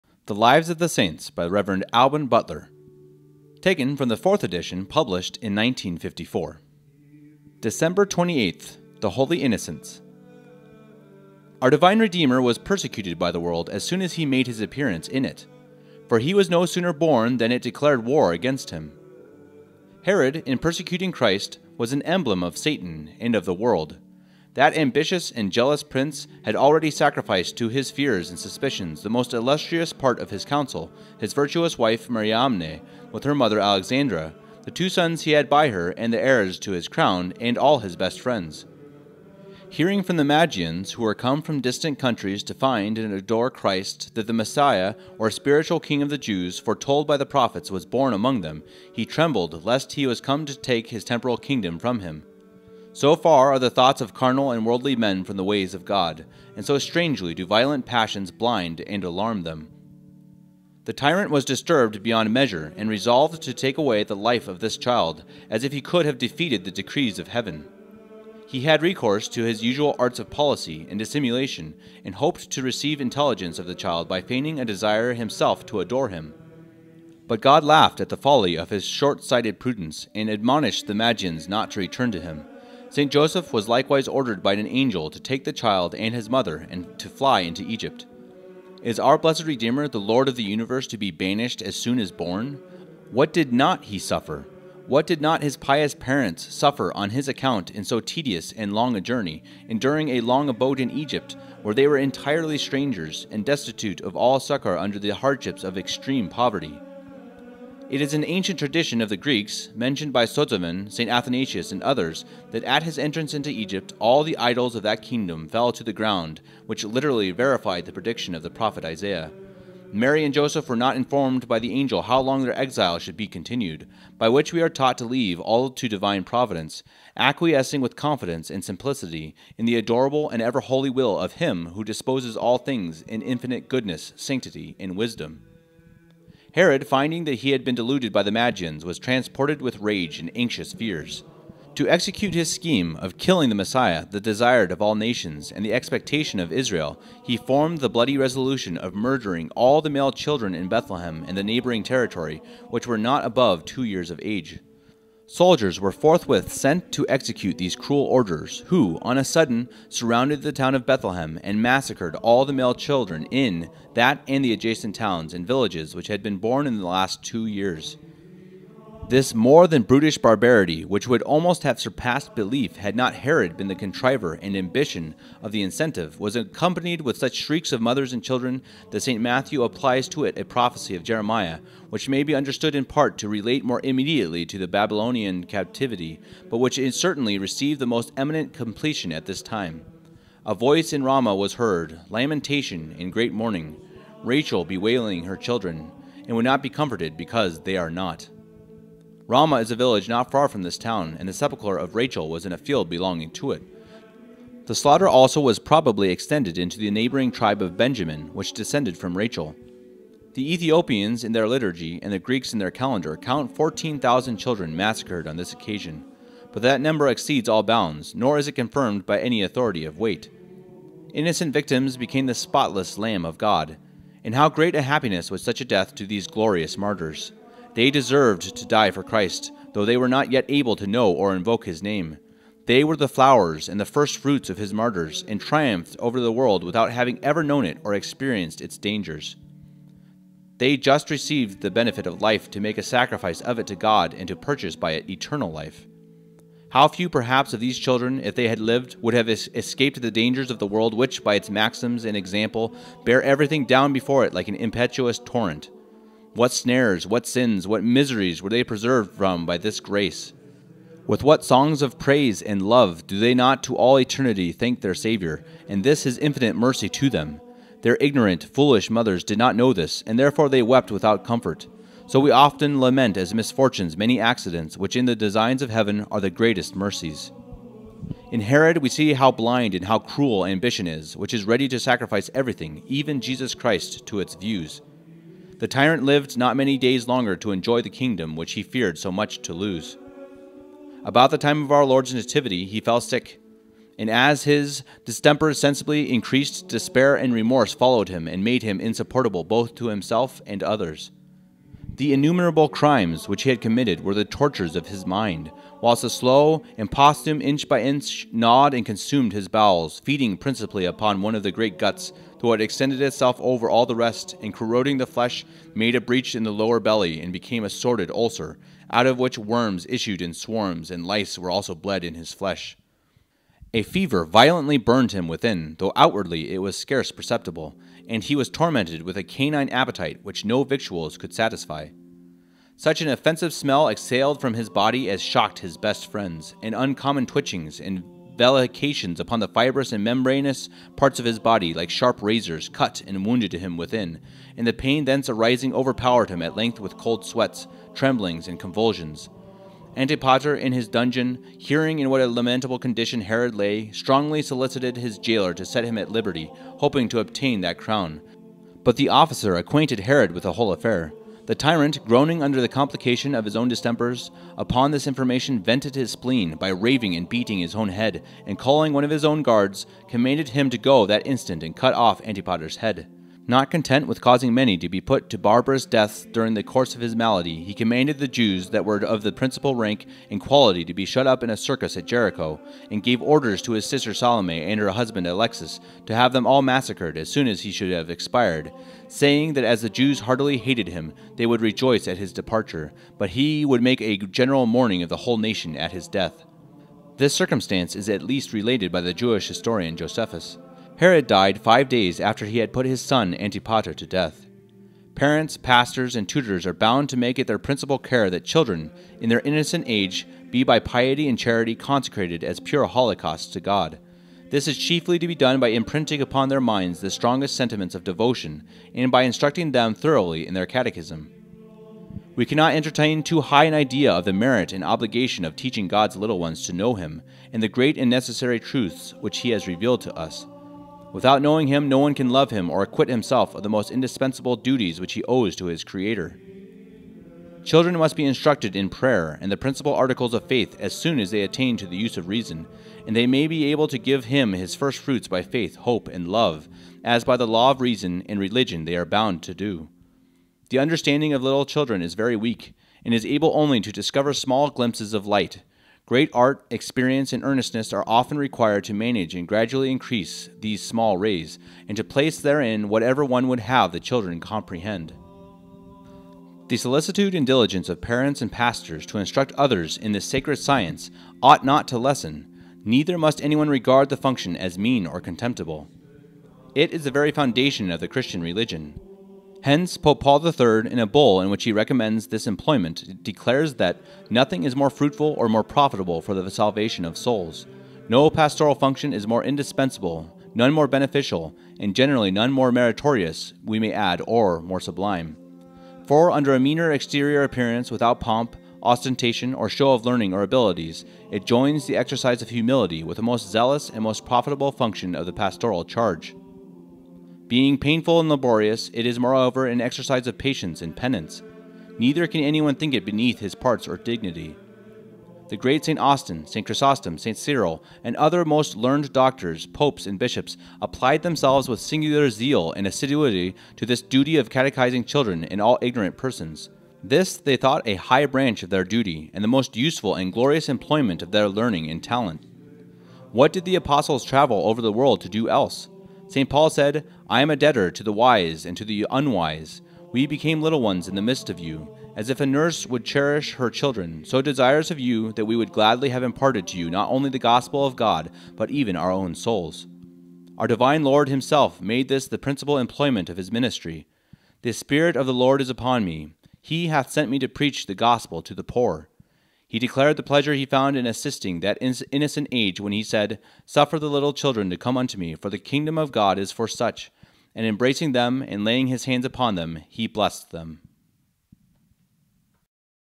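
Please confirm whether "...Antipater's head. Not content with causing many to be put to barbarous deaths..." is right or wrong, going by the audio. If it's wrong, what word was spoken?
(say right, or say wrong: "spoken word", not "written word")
right.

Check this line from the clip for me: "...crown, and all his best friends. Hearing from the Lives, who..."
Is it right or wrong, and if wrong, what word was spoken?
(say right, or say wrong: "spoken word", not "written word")
wrong: "Magians", not "Lives".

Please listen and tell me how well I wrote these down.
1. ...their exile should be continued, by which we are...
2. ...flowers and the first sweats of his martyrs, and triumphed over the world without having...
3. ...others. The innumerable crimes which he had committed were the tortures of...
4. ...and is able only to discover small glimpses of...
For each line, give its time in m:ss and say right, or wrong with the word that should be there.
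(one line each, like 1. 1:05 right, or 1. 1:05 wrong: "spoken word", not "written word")
1. 2:02 right
2. 3:53 wrong: "fruits", not "sweats"
3. 5:00 right
4. 7:33 right.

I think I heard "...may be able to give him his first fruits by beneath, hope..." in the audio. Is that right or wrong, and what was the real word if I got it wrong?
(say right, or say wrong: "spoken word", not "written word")
wrong: "faith", not "beneath".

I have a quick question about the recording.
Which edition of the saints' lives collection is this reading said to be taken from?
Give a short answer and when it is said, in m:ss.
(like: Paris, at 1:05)
4th edition, at 0:04.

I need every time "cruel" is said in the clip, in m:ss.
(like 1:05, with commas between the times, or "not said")
2:37, 4:39.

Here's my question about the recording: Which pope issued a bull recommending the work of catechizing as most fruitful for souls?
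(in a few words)
Pope Paul III.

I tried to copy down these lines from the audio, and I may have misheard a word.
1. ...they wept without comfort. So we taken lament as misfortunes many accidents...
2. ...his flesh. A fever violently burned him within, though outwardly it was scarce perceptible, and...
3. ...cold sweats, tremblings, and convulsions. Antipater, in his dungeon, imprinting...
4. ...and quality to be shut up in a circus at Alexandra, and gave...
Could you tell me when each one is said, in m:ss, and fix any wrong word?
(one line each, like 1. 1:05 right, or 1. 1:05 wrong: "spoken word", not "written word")
1. 4:30 wrong: "often", not "taken"
2. 5:22 right
3. 5:46 wrong: "hearing", not "imprinting"
4. 6:20 wrong: "Jericho", not "Alexandra".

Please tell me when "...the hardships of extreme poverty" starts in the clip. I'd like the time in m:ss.
1:44.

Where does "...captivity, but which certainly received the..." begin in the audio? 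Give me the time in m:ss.
3:05.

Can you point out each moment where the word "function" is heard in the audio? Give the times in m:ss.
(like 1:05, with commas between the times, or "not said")
7:54, 8:08, 8:24.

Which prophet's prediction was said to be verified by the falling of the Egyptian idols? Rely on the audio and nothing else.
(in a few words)
Isaiah.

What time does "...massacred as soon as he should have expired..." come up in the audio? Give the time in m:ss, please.
6:26.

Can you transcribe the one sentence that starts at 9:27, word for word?
And embracing them and laying his hands upon them, he blessed them.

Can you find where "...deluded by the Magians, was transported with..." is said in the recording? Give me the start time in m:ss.
2:17.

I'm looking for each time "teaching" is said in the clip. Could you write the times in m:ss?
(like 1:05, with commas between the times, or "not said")
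7:05.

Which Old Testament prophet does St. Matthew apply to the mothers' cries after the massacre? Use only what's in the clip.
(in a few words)
Jeremiah.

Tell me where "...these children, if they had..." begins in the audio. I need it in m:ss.
4:07.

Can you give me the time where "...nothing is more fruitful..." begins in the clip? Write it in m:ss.
8:04.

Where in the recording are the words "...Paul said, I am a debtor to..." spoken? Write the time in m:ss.
8:56.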